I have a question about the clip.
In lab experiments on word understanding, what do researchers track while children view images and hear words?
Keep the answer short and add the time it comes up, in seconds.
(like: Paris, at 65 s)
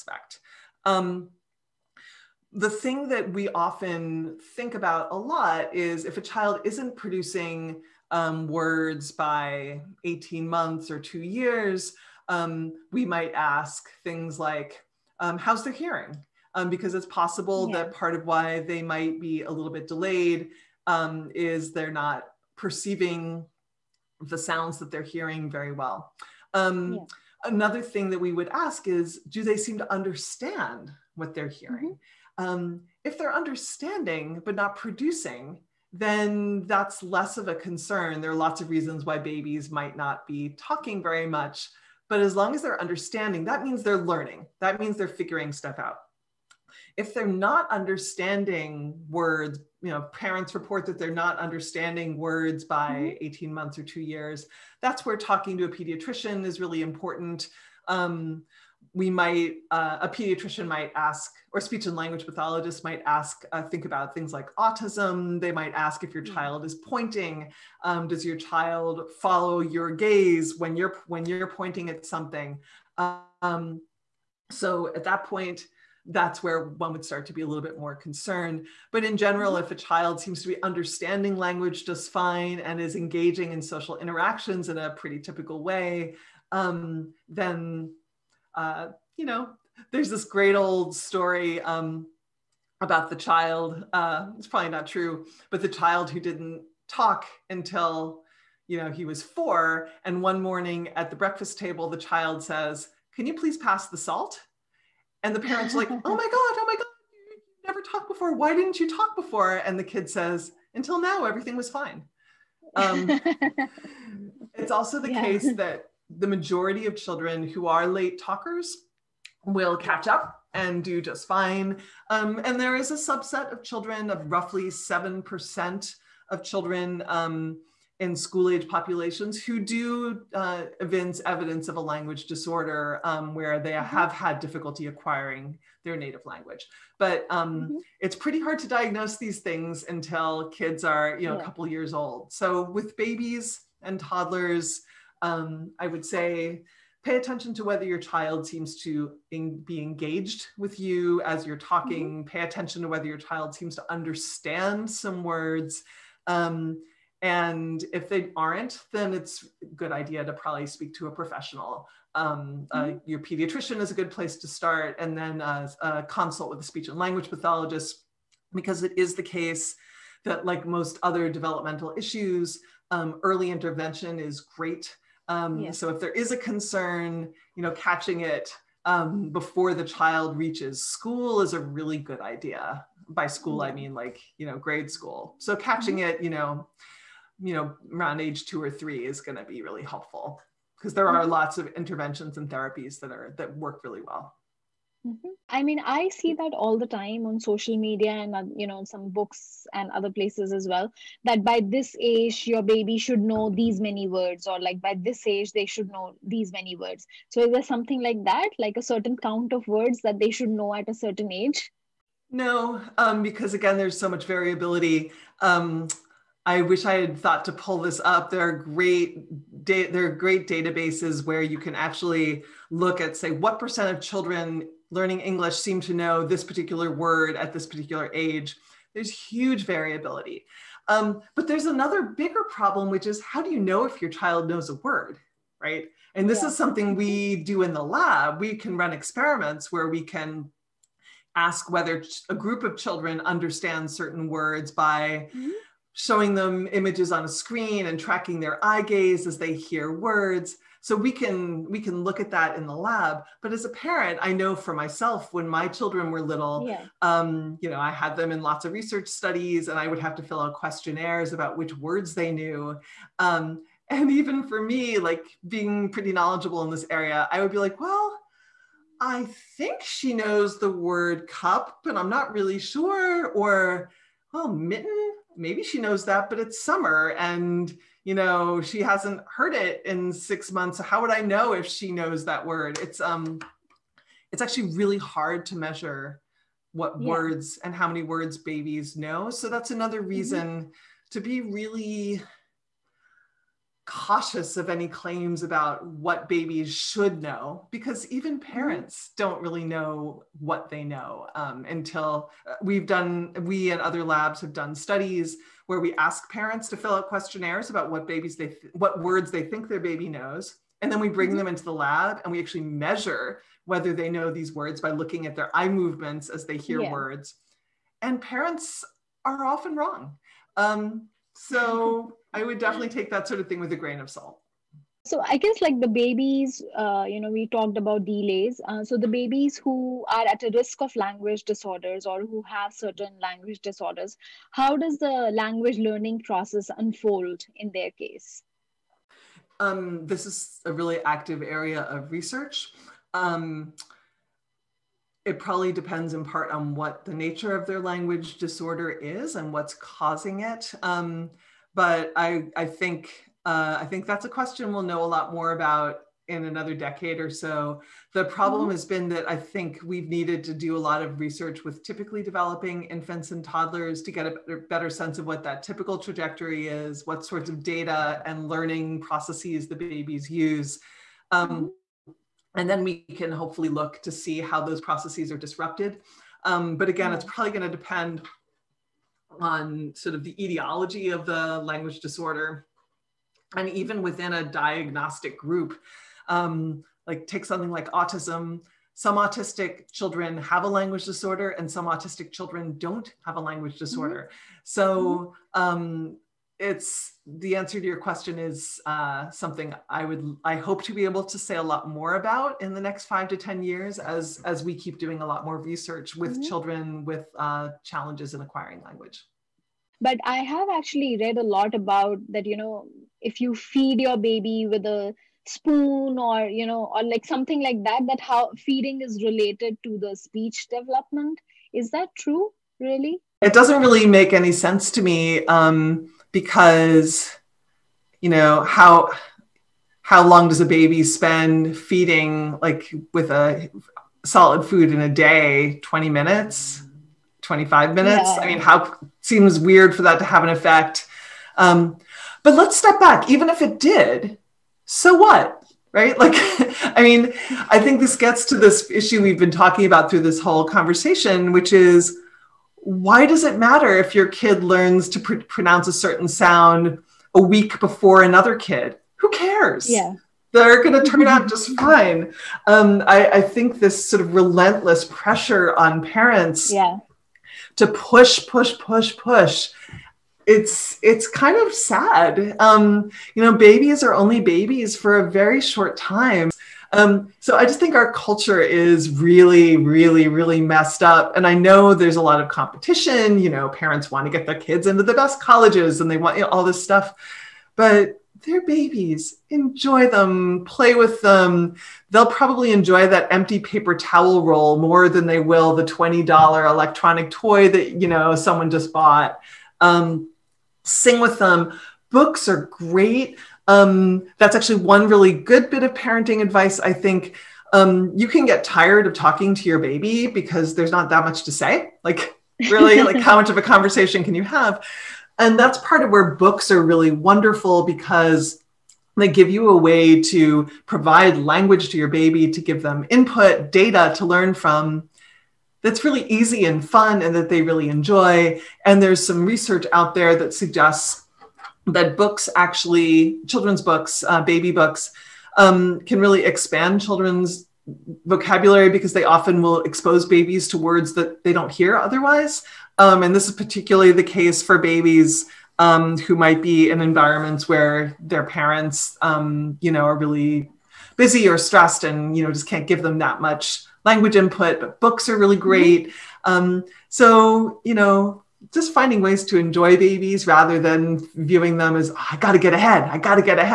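eye gaze, at 248 s.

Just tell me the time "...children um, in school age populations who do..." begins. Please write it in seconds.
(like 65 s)
126 s.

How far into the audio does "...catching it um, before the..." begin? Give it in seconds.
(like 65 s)
177 s.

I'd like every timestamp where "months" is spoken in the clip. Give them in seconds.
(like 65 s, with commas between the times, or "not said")
10 s, 53 s, 280 s.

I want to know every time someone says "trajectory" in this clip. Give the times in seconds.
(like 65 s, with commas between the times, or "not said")
365 s.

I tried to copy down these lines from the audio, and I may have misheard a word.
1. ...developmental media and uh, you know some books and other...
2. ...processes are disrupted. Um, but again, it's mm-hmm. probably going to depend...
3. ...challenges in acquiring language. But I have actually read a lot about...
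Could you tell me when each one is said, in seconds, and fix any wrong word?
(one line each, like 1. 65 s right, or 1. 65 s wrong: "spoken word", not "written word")
1. 197 s wrong: "social", not "developmental"
2. 374 s right
3. 407 s right.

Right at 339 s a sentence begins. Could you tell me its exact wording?
Um, this is a really active area of research.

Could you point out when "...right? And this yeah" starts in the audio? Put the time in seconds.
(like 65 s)
235 s.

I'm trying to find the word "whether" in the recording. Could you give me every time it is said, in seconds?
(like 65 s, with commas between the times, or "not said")
147 s, 152 s, 241 s, 313 s.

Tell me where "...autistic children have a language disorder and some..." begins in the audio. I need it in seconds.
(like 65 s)
389 s.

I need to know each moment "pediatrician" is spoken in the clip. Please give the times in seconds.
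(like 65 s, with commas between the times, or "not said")
55 s, 60 s, 163 s.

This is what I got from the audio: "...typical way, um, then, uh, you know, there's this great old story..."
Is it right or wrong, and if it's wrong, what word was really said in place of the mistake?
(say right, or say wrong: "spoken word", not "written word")
right.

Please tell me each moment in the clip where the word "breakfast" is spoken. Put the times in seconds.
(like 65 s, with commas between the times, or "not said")
101 s.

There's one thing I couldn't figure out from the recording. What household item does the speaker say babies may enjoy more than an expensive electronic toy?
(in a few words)
empty paper towel roll.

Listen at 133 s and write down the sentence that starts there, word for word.
have had difficulty acquiring their native language.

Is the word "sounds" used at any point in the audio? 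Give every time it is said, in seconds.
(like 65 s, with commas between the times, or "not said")
24 s, 456 s.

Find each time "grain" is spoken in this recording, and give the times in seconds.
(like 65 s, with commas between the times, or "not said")
323 s.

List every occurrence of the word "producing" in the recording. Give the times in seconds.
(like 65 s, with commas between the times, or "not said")
6 s, 34 s.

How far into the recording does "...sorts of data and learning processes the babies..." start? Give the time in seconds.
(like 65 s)
367 s.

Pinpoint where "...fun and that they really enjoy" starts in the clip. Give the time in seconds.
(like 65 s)
526 s.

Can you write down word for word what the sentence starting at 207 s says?
So is there something like that, like a certain count of words that they should know at a certain age?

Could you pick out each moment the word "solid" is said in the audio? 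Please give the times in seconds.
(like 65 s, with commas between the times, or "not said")
434 s.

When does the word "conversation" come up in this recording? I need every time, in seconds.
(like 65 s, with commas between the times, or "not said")
450 s, 513 s.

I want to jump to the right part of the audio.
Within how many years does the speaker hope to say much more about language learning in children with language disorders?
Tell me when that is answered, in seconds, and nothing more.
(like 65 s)
403 s.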